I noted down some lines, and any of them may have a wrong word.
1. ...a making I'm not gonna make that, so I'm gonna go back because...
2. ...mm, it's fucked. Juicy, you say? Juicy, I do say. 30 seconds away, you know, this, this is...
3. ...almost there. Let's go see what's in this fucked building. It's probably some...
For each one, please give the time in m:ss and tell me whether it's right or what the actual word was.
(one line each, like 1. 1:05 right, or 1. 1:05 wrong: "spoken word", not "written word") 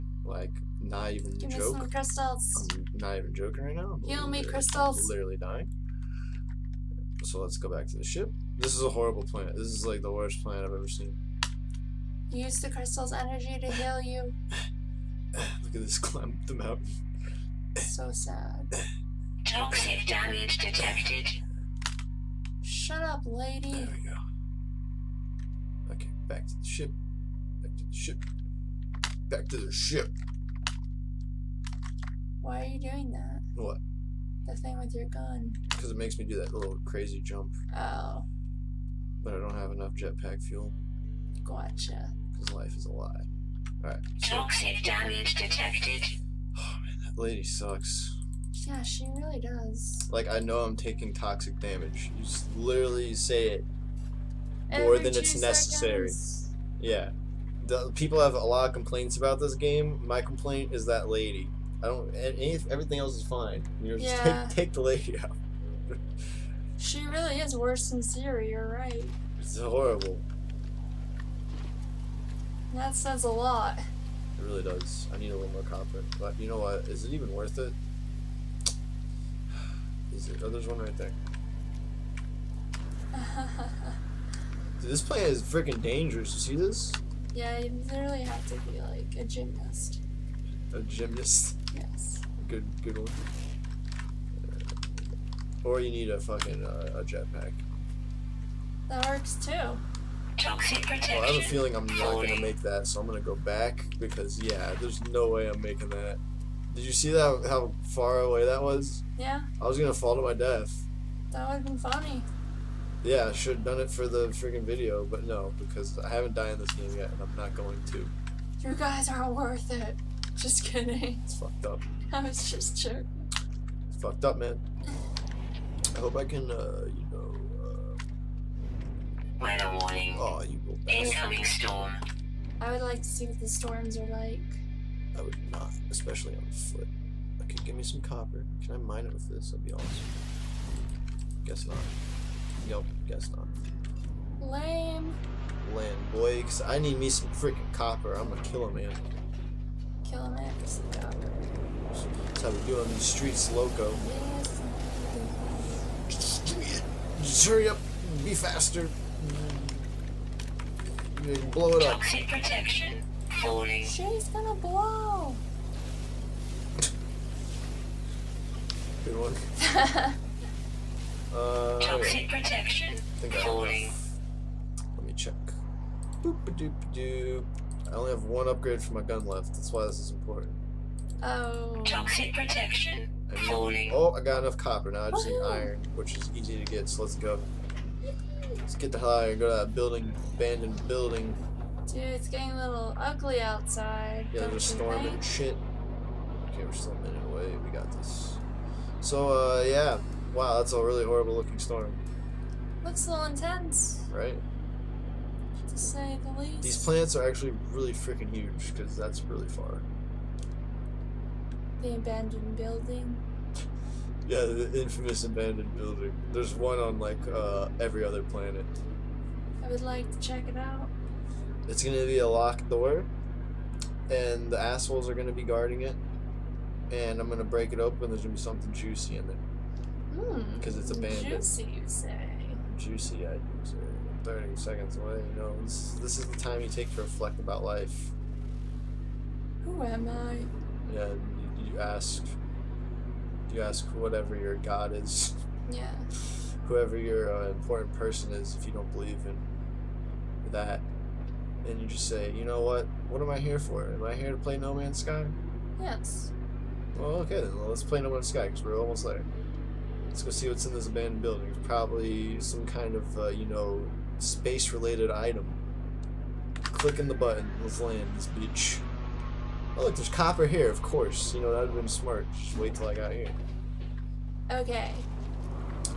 1. 1:41 wrong: "feeling", not "making"
2. 3:50 wrong: "abandoned", not "fucked"
3. 4:18 wrong: "abandoned", not "fucked".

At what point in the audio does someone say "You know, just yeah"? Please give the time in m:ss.
1:03.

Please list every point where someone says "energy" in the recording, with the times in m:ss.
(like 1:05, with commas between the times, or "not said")
0:13.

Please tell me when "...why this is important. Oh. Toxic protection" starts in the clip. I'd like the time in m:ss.
2:59.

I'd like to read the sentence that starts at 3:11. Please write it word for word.
Dude, it's getting a little ugly outside.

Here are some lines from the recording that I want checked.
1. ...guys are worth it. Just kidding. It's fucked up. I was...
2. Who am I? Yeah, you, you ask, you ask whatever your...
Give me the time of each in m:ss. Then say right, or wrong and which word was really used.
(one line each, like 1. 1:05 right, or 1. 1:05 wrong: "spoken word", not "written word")
1. 1:58 right
2. 3:59 right.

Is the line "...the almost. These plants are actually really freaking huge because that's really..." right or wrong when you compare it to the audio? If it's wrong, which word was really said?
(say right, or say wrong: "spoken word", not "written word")
wrong: "least", not "almost".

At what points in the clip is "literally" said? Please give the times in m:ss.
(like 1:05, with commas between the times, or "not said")
0:05, 0:52, 1:27.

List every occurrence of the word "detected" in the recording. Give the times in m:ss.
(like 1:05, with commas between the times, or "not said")
0:20, 0:45.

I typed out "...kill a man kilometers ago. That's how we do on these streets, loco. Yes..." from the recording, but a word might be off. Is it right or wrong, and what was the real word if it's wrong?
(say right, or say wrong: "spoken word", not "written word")
right.